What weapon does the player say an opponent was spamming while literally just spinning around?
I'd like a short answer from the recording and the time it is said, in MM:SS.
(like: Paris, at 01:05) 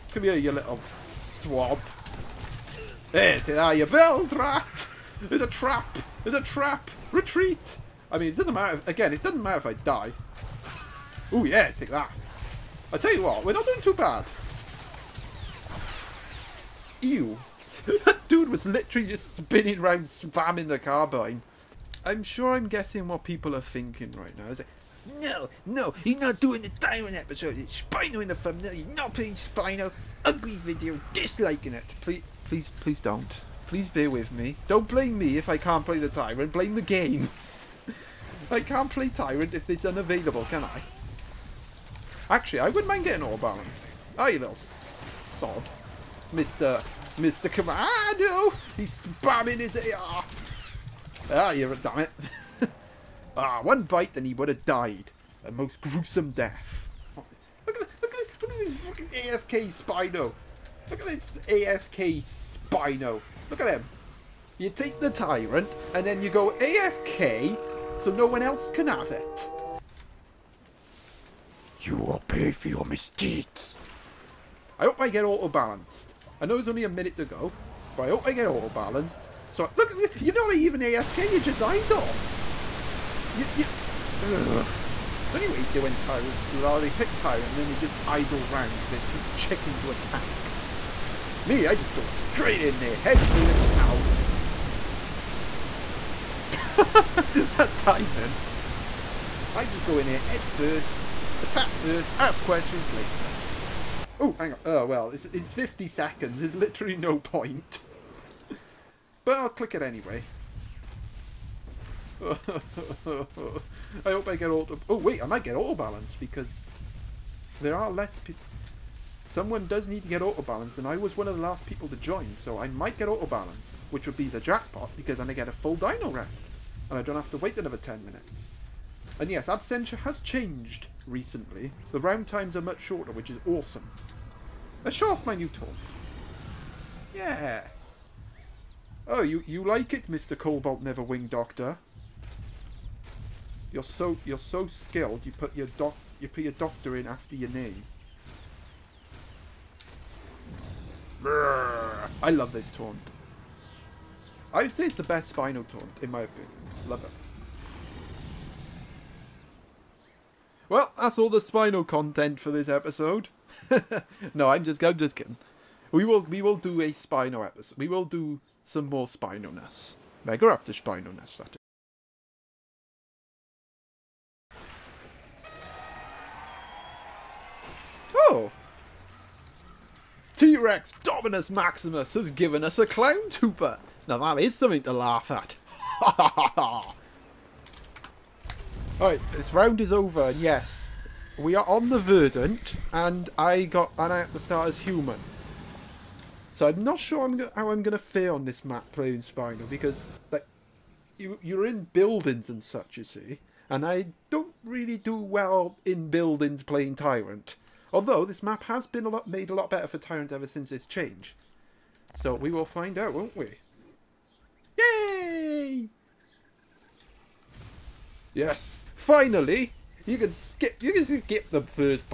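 carbine, at 00:20.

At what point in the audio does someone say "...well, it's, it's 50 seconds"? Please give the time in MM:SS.
01:44.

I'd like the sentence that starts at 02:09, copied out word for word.
And yes, Absentia has changed recently.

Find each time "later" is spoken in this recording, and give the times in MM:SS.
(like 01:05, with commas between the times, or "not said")
01:42.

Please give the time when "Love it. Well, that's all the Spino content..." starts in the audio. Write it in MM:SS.
02:36.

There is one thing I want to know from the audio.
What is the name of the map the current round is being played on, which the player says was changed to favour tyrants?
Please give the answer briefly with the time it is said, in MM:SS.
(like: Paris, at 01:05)
Verdant, at 03:11.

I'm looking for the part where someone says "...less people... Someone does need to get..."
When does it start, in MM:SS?
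01:57.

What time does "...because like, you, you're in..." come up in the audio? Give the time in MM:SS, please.
03:19.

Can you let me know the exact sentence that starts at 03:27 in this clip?
Although this map has been a lot made a lot better for Tyrant ever since its change.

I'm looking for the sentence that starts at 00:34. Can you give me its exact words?
Don't blame me if I can't play the Tyrant.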